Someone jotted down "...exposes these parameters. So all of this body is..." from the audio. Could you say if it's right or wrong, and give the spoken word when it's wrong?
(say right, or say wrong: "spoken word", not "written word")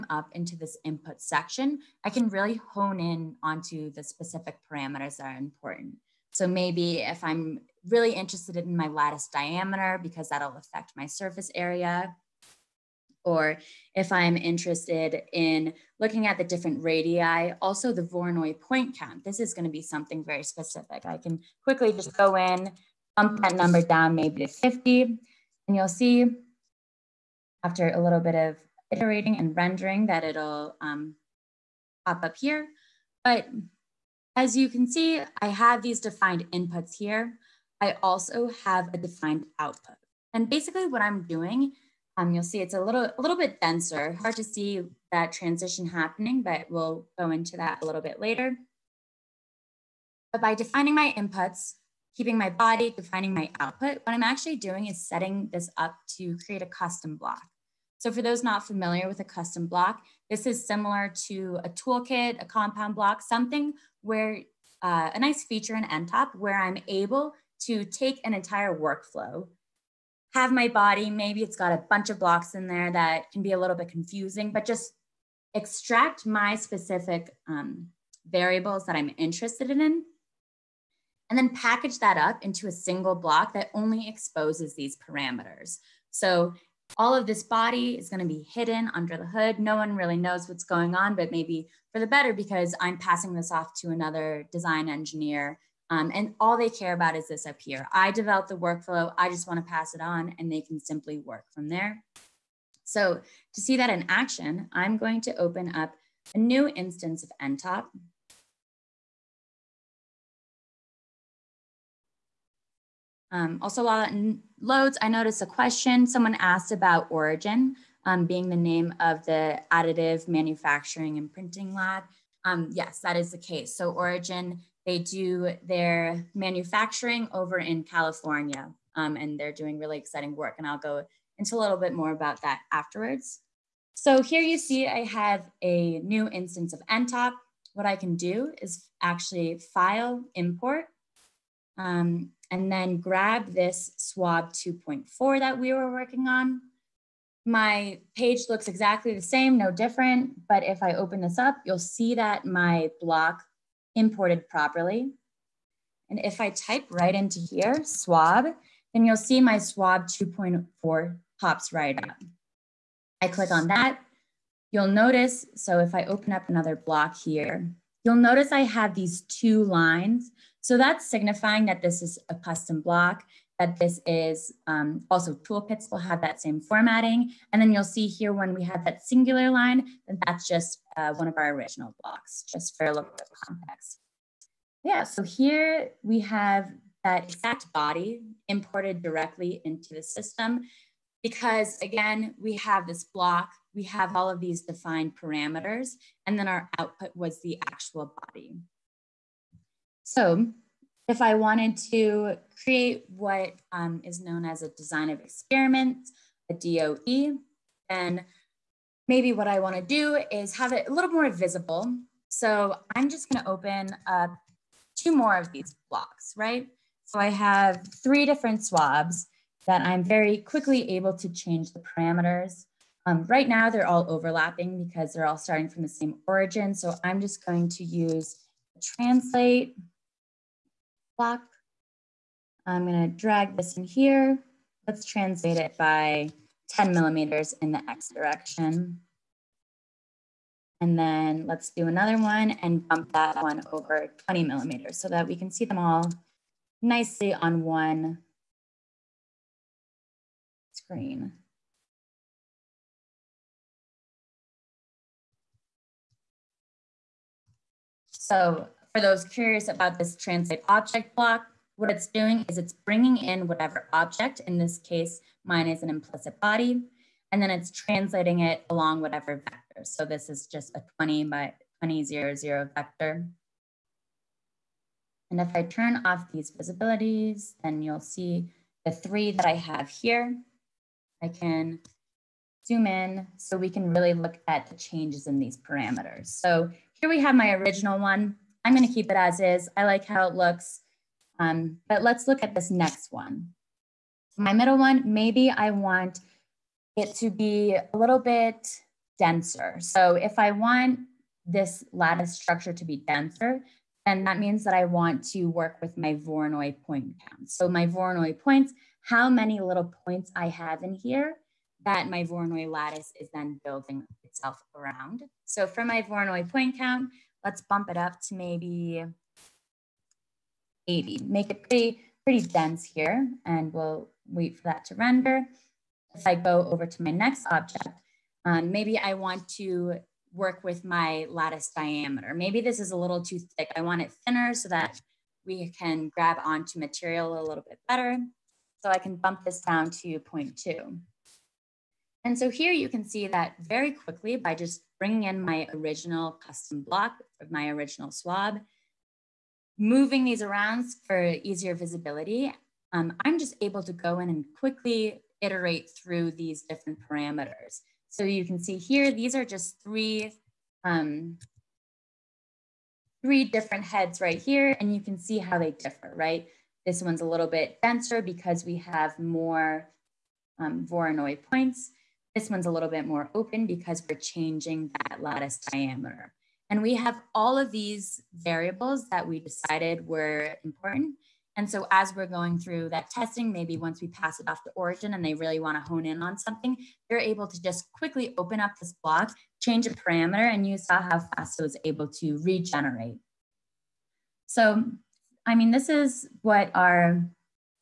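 right.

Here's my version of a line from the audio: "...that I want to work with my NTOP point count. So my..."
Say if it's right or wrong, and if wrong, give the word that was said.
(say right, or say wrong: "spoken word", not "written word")
wrong: "Voronoi", not "NTOP".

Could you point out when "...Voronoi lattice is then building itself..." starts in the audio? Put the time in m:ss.
5:12.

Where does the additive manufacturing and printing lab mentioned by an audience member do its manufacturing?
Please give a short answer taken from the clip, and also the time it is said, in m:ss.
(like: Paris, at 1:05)
California, at 2:07.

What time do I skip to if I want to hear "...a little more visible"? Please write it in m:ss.
3:30.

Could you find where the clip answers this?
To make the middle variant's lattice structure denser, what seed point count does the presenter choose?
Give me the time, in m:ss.
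5:20.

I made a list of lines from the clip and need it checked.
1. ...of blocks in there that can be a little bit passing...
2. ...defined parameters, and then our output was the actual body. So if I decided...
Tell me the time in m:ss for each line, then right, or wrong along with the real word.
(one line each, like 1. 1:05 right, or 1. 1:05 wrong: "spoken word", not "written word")
1. 1:12 wrong: "confusing", not "passing"
2. 3:14 wrong: "wanted", not "decided".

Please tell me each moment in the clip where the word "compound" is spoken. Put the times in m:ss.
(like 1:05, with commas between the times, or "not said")
1:02.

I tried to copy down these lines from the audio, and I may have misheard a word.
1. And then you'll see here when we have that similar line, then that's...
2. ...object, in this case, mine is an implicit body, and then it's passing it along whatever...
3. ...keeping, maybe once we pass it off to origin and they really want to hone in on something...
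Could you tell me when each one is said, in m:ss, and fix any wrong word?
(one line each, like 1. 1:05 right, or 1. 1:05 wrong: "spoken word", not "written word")
1. 2:57 wrong: "singular", not "similar"
2. 4:23 wrong: "translating", not "passing"
3. 6:23 wrong: "testing", not "keeping".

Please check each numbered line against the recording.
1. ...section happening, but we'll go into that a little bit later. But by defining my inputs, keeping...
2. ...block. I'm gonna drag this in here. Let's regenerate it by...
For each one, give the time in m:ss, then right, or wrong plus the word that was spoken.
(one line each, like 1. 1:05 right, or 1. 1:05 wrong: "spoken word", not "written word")
1. 0:45 wrong: "transition", not "section"
2. 3:51 wrong: "translate", not "regenerate".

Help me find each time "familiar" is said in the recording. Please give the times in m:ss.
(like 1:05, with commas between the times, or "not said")
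0:58.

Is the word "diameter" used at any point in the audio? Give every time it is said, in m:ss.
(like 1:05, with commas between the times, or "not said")
0:09, 5:31, 6:15.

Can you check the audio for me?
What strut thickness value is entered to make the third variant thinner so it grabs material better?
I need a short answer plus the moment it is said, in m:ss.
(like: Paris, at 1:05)
0.2, at 5:40.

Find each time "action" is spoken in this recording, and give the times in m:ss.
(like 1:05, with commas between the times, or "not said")
1:44.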